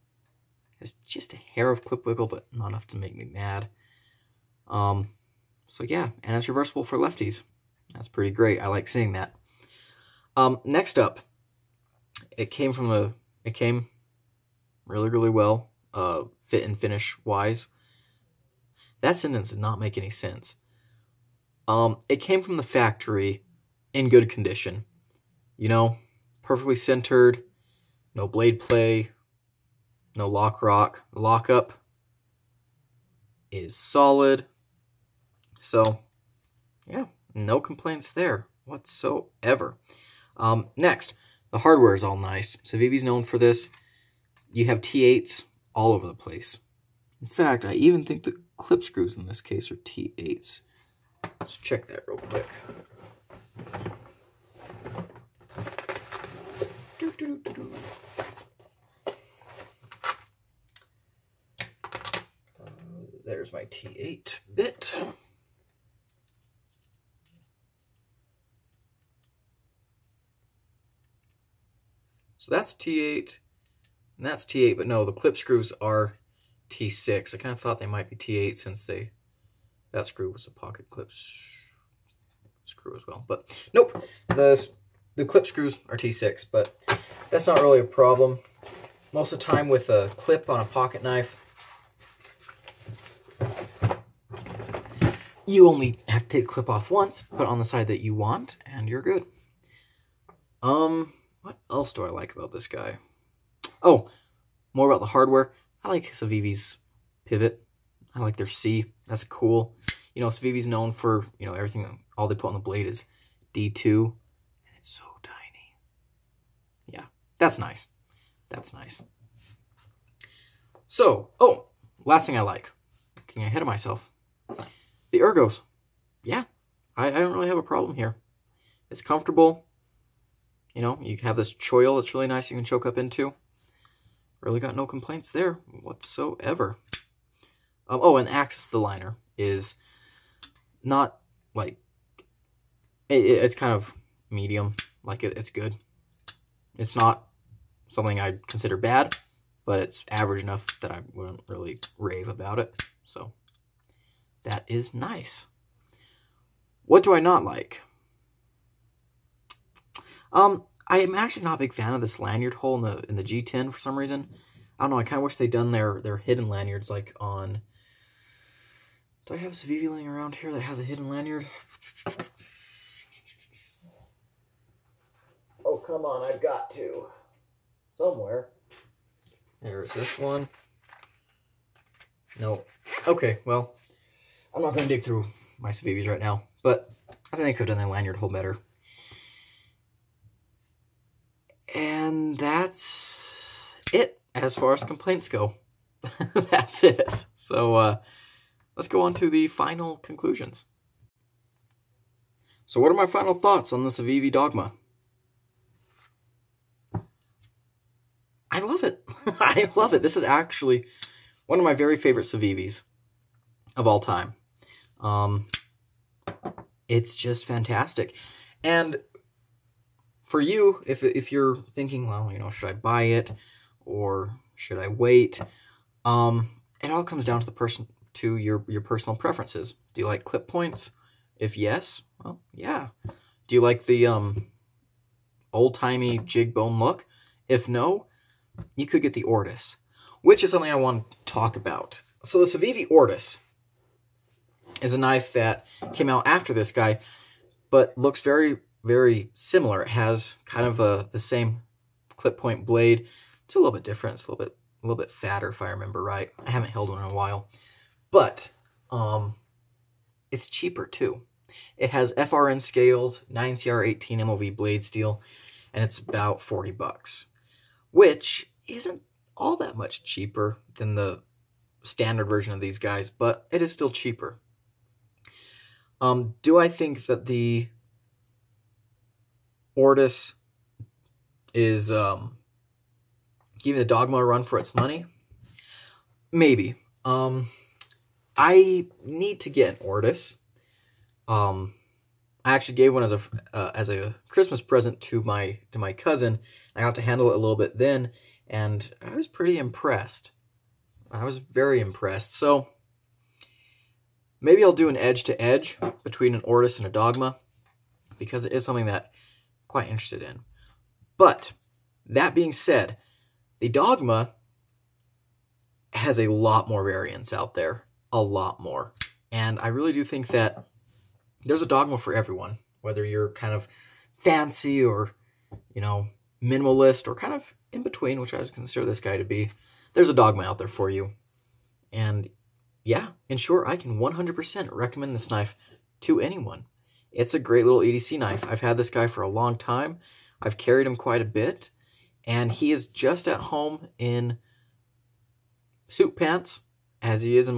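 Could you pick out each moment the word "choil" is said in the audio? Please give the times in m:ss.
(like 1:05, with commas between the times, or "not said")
2:11.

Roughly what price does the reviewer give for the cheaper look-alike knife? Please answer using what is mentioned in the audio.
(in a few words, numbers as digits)
$40.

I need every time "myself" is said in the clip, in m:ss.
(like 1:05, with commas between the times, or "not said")
2:03.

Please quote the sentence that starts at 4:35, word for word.
Um, do I think that the Ortis is um, giving the dogma a run for its money.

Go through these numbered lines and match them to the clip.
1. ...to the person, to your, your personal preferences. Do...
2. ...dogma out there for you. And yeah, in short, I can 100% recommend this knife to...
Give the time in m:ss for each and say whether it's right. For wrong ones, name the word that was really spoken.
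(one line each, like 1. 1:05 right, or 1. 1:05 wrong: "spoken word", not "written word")
1. 3:47 right
2. 5:30 right.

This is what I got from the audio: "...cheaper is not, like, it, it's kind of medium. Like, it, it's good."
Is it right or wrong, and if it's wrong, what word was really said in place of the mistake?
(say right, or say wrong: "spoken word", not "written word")
wrong: "liner", not "cheaper".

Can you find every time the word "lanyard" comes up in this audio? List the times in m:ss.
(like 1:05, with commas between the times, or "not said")
2:42, 2:46, 2:51, 3:07.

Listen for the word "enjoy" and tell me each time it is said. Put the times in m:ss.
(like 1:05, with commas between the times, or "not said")
not said.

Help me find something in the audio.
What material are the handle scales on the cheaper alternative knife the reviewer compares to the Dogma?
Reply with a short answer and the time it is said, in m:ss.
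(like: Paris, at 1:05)
FRN, at 4:22.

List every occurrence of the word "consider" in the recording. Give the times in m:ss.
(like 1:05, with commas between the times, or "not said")
2:28, 5:28.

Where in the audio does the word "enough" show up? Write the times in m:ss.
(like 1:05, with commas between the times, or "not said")
0:02, 2:30.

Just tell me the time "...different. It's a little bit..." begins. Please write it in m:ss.
4:13.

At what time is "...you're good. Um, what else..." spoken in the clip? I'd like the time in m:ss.
1:38.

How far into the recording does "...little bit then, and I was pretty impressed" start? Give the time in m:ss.
4:57.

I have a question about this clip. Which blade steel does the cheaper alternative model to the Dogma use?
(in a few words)
9Cr18MoV.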